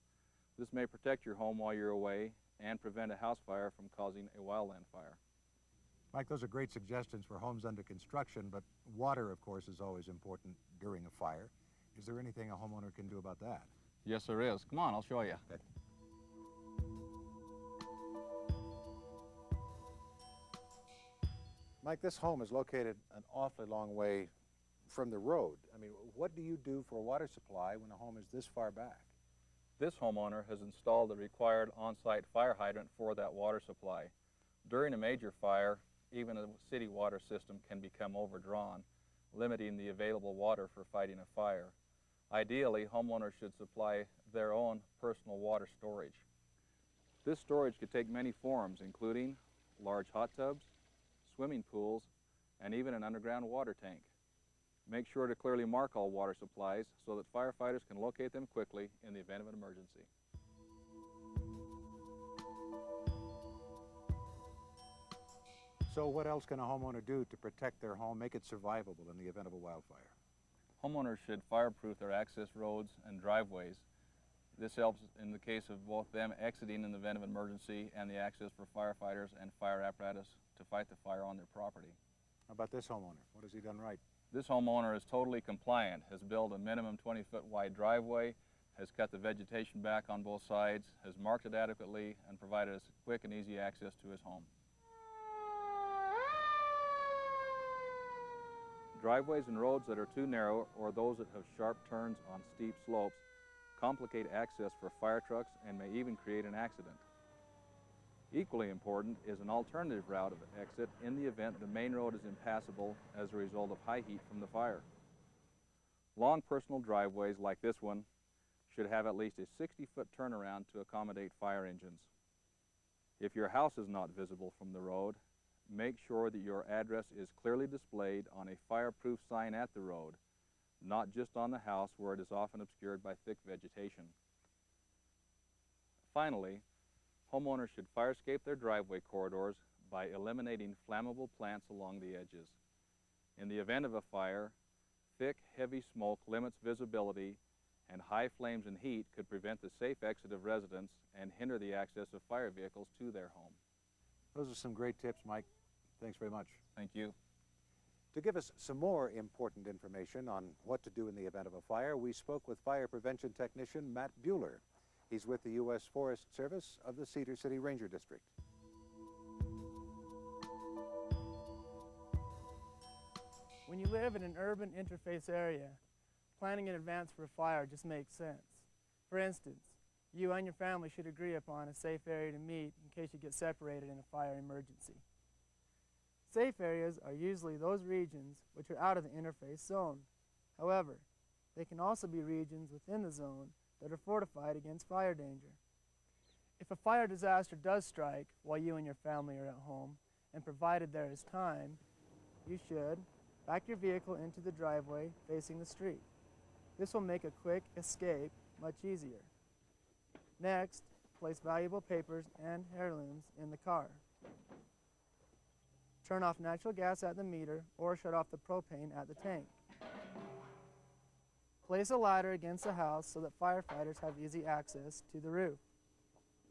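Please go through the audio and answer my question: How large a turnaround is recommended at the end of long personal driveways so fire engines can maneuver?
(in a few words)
60 feet.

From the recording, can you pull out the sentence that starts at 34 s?
During a major fire, even a city water system can become overdrawn, limiting the available water for fighting a fire.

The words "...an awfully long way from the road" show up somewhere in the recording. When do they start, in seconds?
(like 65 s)
23 s.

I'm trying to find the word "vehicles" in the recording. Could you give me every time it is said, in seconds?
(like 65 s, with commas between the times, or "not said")
152 s, 203 s.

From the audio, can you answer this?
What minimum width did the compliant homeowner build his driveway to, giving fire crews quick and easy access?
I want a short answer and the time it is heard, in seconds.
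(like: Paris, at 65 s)
20 feet, at 87 s.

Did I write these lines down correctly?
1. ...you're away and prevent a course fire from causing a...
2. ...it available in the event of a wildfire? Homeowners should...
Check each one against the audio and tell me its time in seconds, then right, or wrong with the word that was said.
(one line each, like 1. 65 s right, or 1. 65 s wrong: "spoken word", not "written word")
1. 1 s wrong: "house", not "course"
2. 68 s wrong: "survivable", not "available".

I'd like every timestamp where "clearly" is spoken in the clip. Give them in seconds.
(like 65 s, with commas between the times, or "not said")
55 s, 127 s.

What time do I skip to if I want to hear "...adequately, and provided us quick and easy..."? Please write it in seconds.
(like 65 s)
91 s.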